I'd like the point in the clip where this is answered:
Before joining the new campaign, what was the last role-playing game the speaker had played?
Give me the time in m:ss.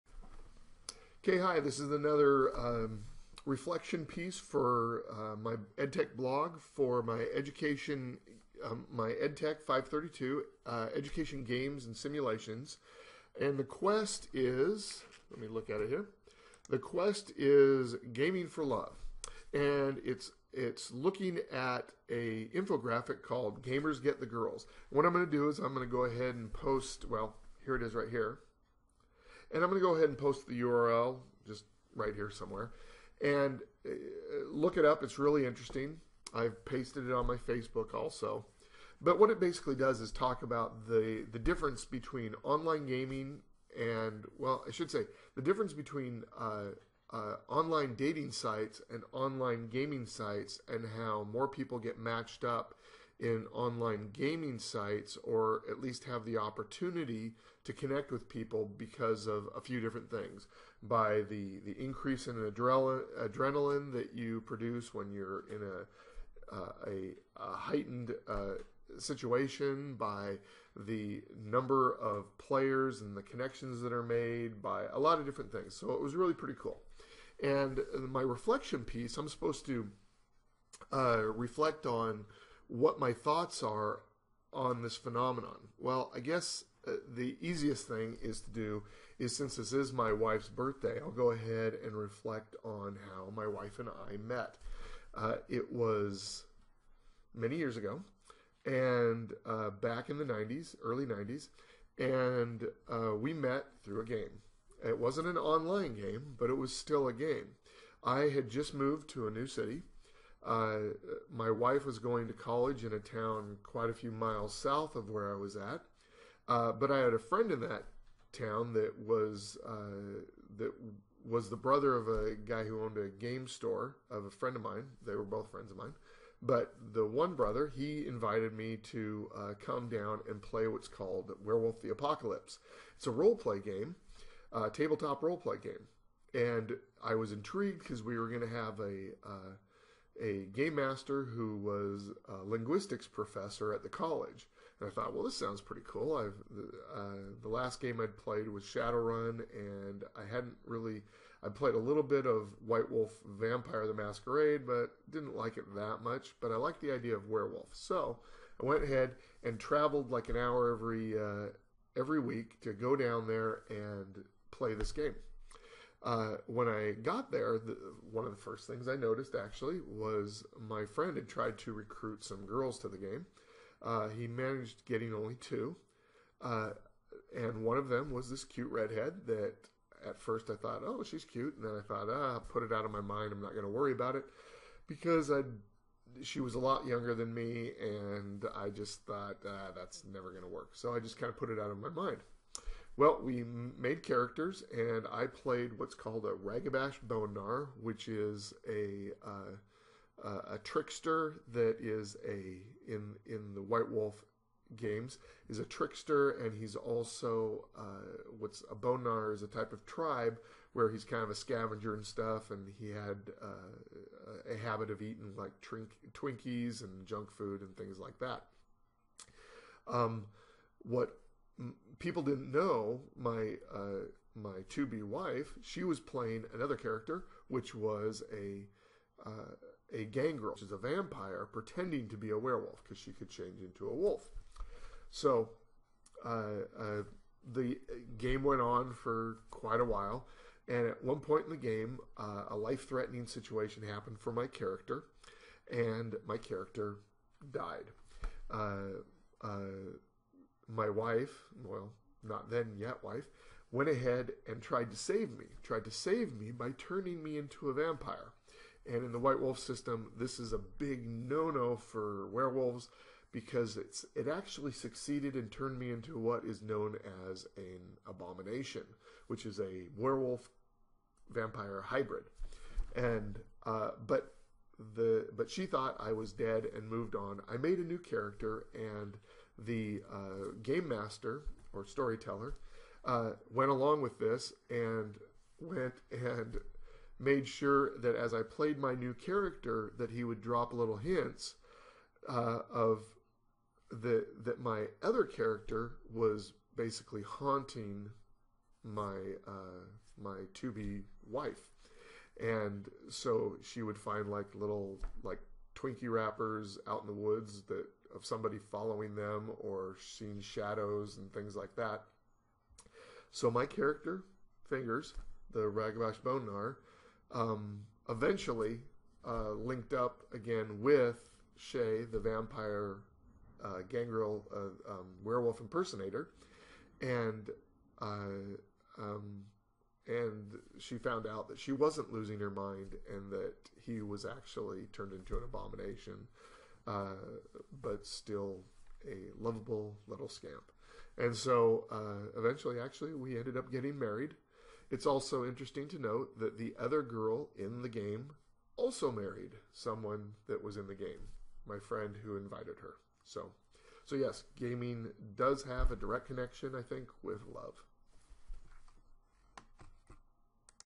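2:28.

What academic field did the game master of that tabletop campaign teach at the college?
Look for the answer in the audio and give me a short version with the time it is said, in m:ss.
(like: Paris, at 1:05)
linguistics, at 2:22.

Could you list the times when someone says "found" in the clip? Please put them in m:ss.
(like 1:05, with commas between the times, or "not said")
5:30.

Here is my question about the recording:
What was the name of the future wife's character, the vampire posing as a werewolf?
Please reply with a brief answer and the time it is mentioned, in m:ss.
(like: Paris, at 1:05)
Shay, at 5:21.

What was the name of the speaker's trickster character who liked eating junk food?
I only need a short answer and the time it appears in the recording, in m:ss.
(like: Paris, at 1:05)
Fingers, at 5:14.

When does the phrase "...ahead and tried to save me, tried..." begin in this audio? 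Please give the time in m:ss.
4:13.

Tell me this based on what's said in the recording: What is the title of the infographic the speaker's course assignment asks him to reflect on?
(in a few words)
Gamers Get the Girls.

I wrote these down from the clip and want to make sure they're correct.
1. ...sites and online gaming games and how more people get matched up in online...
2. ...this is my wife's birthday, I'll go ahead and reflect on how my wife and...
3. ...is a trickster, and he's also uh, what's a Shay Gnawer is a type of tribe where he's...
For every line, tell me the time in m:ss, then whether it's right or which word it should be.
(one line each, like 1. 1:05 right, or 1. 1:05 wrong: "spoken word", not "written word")
1. 0:48 wrong: "sites", not "games"
2. 1:29 right
3. 3:25 wrong: "Bone", not "Shay".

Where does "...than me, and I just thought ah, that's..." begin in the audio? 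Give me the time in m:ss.
3:07.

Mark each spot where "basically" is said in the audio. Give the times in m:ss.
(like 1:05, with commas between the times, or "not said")
0:39, 4:56.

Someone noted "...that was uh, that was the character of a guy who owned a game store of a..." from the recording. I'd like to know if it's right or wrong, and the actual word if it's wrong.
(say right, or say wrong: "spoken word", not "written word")
wrong: "brother", not "character".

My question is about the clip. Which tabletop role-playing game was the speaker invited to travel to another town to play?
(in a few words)
Werewolf the Apocalypse.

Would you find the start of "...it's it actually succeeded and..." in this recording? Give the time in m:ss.
4:23.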